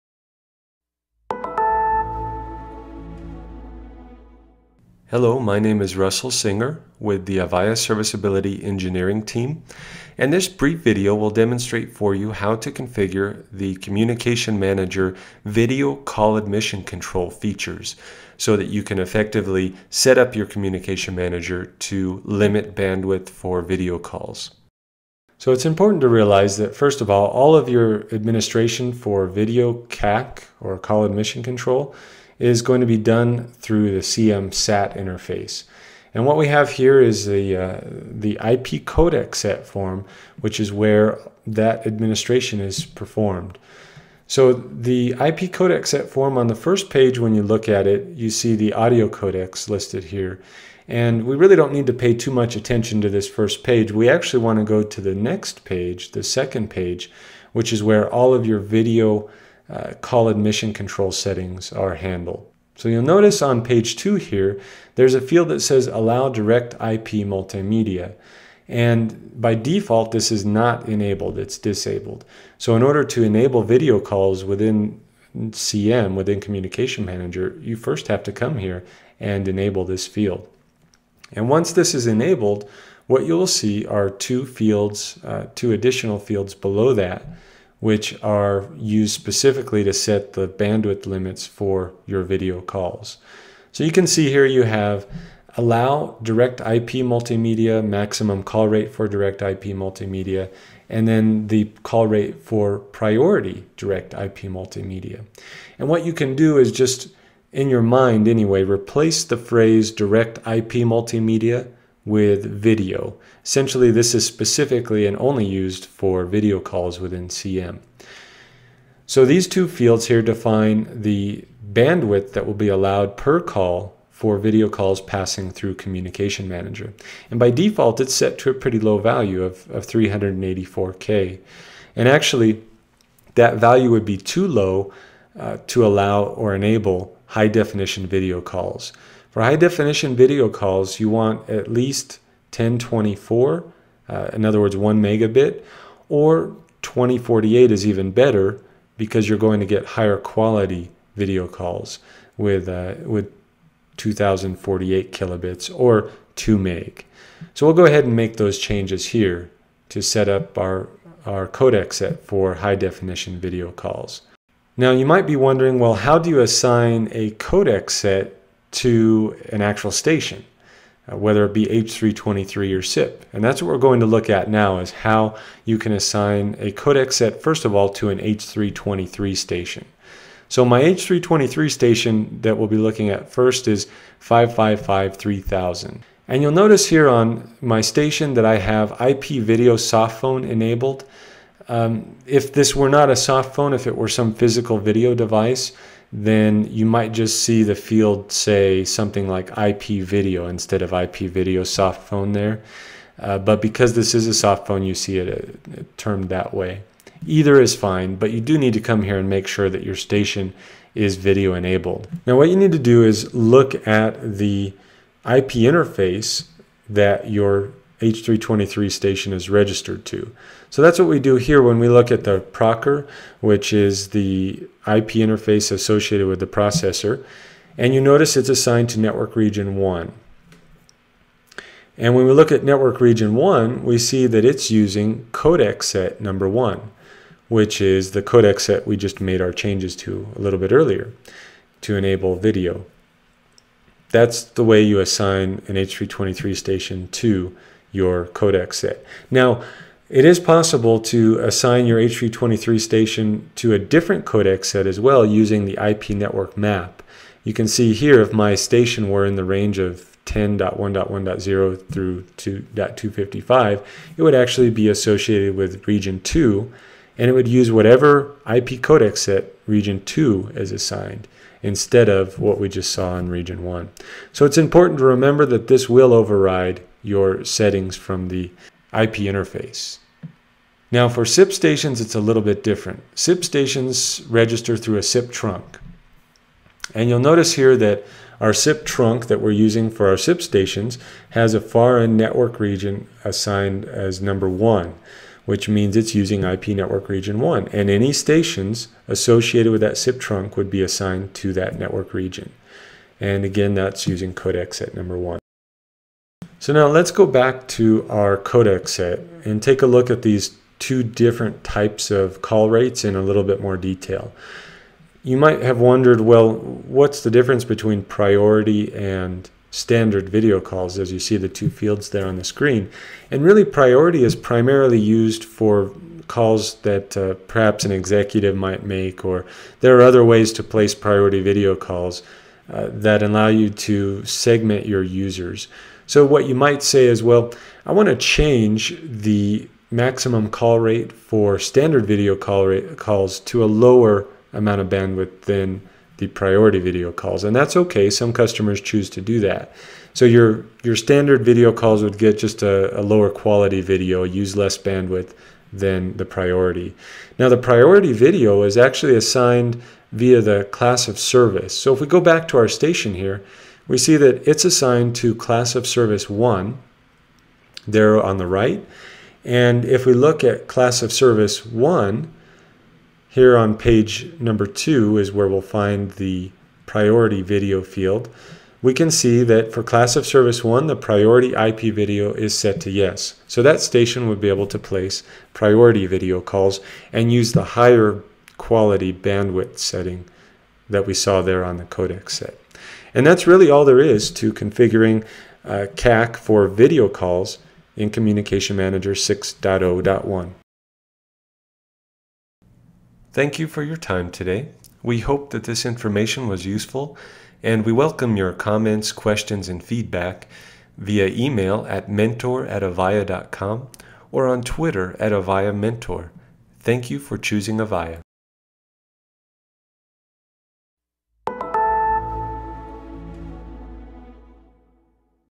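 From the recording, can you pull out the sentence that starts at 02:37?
So we'll go ahead and make those changes here to set up our, our codec set for high definition video calls.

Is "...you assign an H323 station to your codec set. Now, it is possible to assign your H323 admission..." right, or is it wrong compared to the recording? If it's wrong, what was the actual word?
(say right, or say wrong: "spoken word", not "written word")
wrong: "station", not "admission".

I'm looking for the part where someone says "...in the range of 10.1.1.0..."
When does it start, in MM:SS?
04:19.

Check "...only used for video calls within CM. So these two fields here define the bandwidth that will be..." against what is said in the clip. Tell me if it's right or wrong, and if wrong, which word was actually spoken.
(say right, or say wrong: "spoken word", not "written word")
right.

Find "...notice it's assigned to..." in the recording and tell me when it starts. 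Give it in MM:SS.
03:48.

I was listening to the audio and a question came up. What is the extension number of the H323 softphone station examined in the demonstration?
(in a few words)
555 3000.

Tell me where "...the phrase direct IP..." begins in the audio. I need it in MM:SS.
01:49.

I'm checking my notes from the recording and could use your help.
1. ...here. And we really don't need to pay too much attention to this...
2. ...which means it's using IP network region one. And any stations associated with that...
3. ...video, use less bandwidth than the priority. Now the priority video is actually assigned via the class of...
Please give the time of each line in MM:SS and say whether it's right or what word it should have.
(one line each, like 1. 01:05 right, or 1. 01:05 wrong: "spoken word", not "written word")
1. 00:50 right
2. 04:55 right
3. 05:53 right.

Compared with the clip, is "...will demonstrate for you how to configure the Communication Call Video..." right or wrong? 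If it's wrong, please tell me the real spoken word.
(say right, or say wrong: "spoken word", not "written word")
wrong: "Manager", not "Call".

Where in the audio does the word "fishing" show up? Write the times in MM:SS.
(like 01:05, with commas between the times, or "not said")
not said.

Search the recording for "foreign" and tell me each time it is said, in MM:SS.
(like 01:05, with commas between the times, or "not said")
04:51.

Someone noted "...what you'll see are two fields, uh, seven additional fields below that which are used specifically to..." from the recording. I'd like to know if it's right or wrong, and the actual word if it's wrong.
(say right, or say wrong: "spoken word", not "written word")
wrong: "two", not "seven".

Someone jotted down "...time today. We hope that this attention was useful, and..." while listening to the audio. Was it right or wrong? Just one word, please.
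wrong.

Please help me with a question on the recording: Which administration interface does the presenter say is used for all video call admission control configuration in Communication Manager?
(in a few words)
CM SAT.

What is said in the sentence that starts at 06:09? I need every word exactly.
And if we look at class of service 1, here on page number 2 is where we'll find the priority video field.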